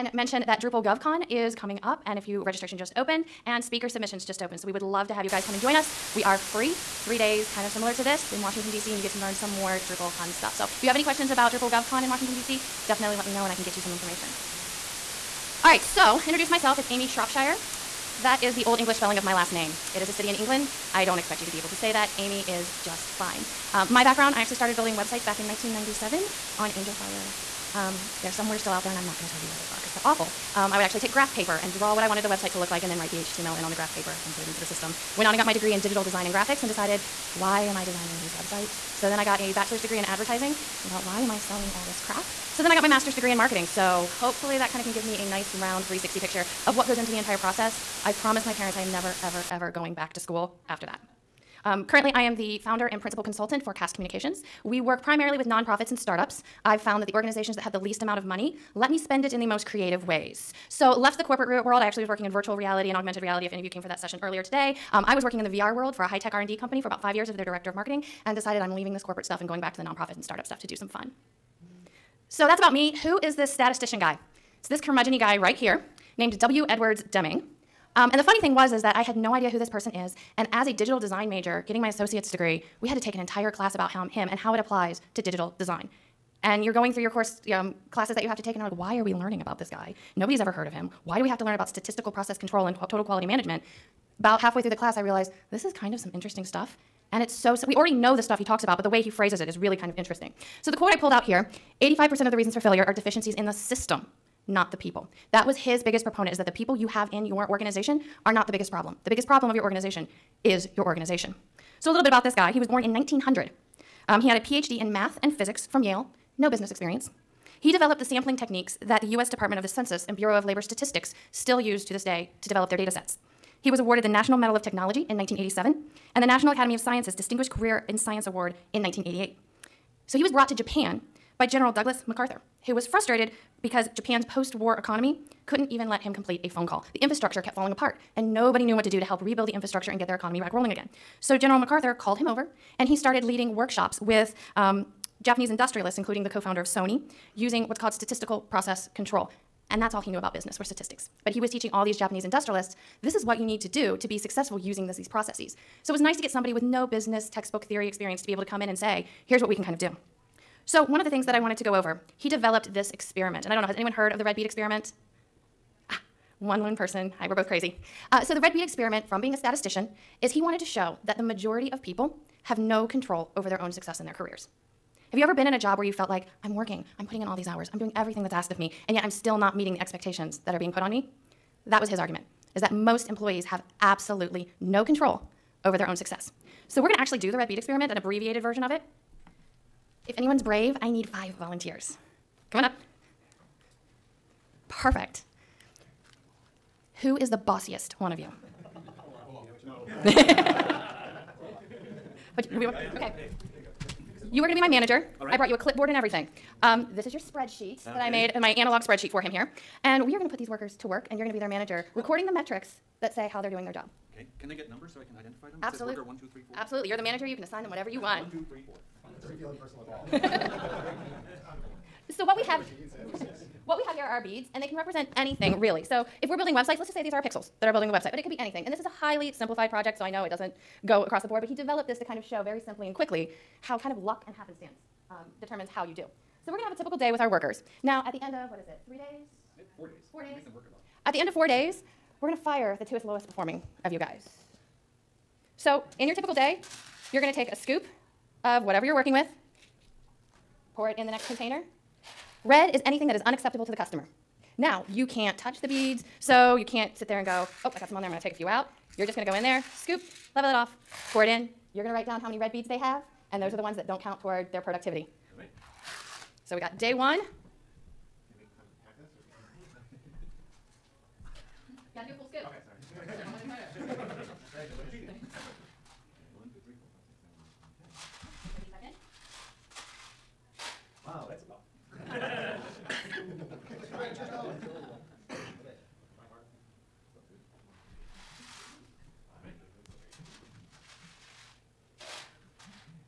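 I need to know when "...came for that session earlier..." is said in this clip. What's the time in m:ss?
1:03.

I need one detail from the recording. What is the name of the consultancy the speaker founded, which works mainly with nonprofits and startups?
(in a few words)
CASK Communications.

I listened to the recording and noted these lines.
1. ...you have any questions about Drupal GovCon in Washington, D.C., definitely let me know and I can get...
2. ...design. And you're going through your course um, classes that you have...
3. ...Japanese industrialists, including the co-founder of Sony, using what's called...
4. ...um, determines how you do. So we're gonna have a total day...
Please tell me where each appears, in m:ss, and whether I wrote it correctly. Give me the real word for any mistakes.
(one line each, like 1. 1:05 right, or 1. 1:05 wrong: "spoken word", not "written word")
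1. 0:10 right
2. 1:25 right
3. 2:25 right
4. 3:55 wrong: "typical", not "total".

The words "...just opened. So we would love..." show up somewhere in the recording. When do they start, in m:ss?
0:04.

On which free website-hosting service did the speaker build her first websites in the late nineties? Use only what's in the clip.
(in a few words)
Angelfire.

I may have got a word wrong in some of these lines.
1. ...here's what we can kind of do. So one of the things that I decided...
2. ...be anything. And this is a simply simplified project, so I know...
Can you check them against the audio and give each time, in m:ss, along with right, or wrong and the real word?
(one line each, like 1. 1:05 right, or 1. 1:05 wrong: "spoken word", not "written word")
1. 2:39 wrong: "wanted", not "decided"
2. 3:48 wrong: "highly", not "simply".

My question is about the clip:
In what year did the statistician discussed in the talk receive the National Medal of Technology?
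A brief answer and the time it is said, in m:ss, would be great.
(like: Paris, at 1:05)
1987, at 2:05.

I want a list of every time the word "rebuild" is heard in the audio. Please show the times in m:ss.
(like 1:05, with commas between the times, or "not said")
2:19.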